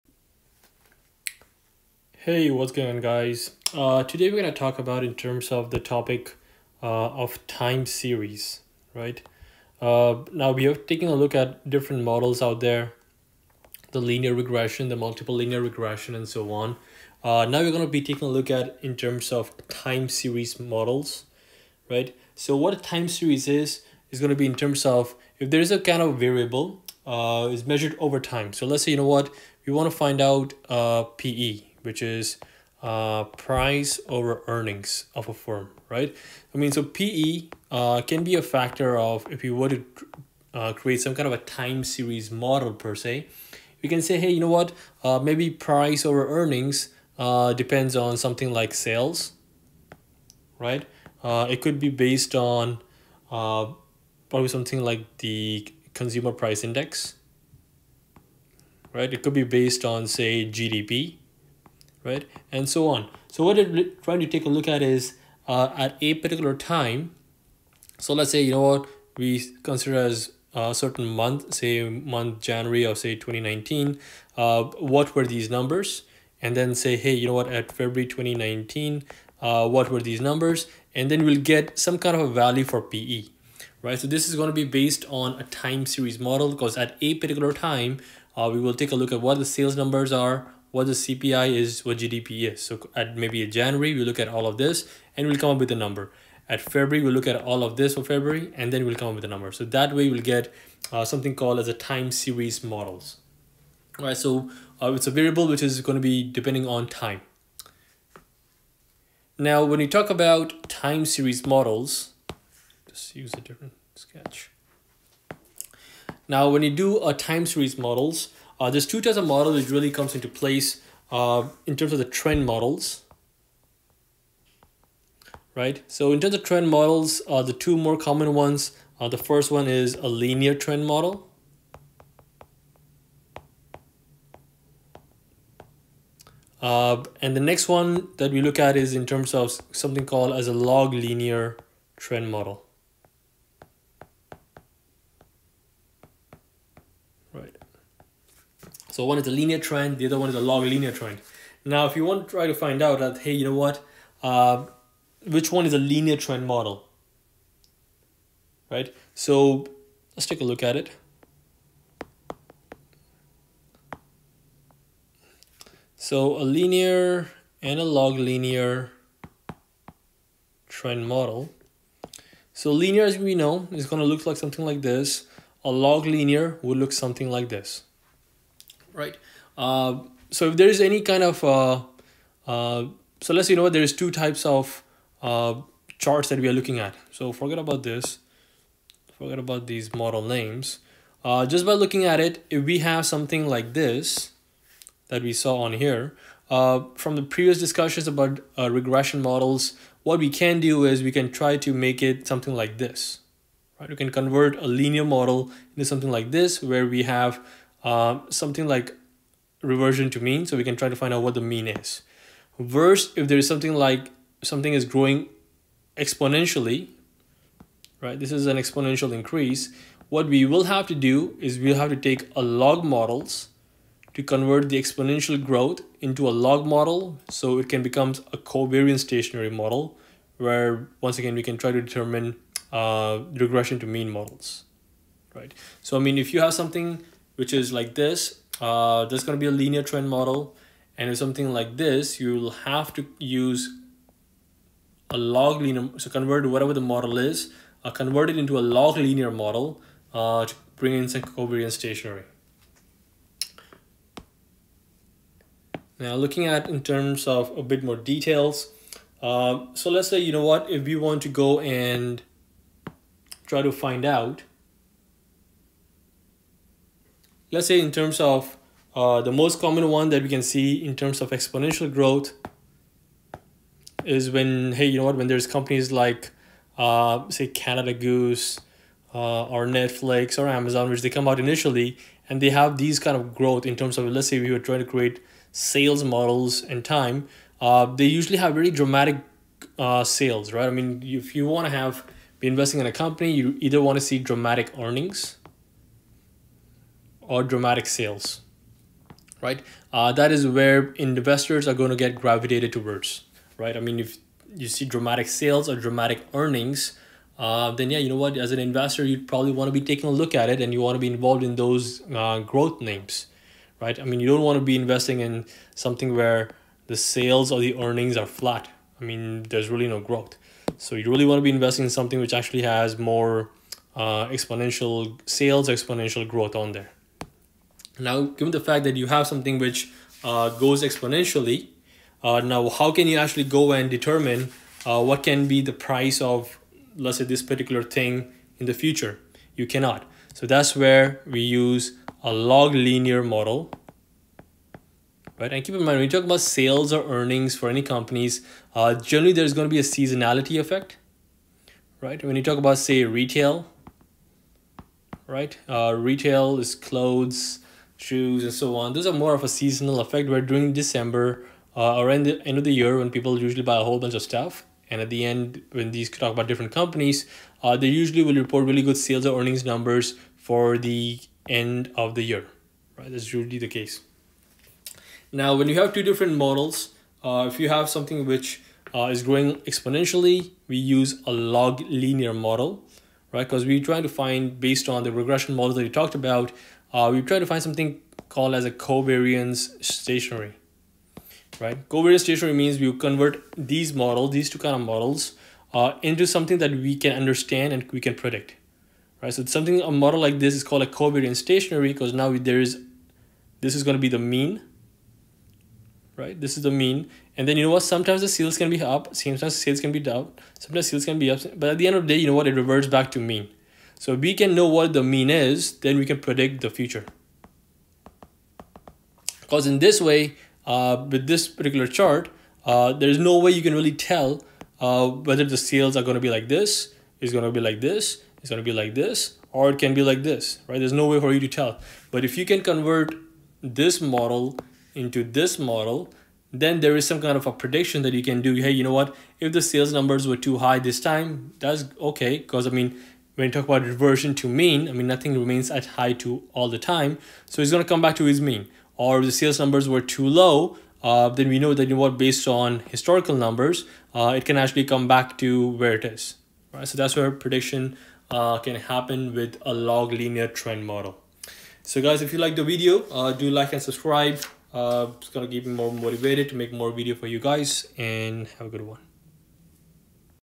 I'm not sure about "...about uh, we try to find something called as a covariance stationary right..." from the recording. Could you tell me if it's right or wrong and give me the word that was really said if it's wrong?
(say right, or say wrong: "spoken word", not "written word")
right.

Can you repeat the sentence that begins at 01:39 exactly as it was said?
So that way we'll get uh, something called as a time series models.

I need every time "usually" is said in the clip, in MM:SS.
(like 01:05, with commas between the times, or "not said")
04:48, 06:03, 06:07, 06:13.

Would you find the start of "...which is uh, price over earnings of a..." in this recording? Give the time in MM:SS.
00:31.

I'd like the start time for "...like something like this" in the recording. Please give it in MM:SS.
02:54.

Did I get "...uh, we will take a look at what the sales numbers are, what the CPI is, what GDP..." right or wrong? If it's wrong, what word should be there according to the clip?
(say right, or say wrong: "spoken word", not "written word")
right.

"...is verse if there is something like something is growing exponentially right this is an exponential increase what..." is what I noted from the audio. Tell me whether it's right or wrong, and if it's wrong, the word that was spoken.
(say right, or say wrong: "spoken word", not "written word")
right.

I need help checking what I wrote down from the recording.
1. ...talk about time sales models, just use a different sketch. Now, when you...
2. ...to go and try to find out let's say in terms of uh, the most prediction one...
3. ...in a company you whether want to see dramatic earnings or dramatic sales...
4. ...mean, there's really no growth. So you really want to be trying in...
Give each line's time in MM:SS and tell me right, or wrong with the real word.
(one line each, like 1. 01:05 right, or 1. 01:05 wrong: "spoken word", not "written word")
1. 01:49 wrong: "series", not "sales"
2. 04:21 wrong: "common", not "prediction"
3. 04:52 wrong: "either", not "whether"
4. 05:19 wrong: "investing", not "trying".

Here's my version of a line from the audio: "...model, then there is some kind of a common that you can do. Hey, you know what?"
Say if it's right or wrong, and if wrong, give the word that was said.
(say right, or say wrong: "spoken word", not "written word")
wrong: "prediction", not "common".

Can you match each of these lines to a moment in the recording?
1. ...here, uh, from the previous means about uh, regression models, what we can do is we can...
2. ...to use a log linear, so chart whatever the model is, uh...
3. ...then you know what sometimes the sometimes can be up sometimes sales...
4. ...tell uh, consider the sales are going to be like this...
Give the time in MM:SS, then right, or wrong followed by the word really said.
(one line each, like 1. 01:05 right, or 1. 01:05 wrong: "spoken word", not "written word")
1. 03:15 wrong: "discussions", not "means"
2. 04:02 wrong: "convert", not "chart"
3. 06:47 wrong: "sales", not "sometimes"
4. 07:03 wrong: "whether", not "consider".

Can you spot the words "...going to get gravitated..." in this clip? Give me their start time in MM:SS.
05:01.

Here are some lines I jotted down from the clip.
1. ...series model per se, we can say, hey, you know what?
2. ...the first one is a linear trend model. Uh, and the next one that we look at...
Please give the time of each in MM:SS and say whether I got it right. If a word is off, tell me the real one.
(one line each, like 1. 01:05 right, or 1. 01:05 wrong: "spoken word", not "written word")
1. 00:41 right
2. 02:09 right.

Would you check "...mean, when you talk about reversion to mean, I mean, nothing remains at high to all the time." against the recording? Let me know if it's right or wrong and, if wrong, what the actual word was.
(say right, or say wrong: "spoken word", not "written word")
right.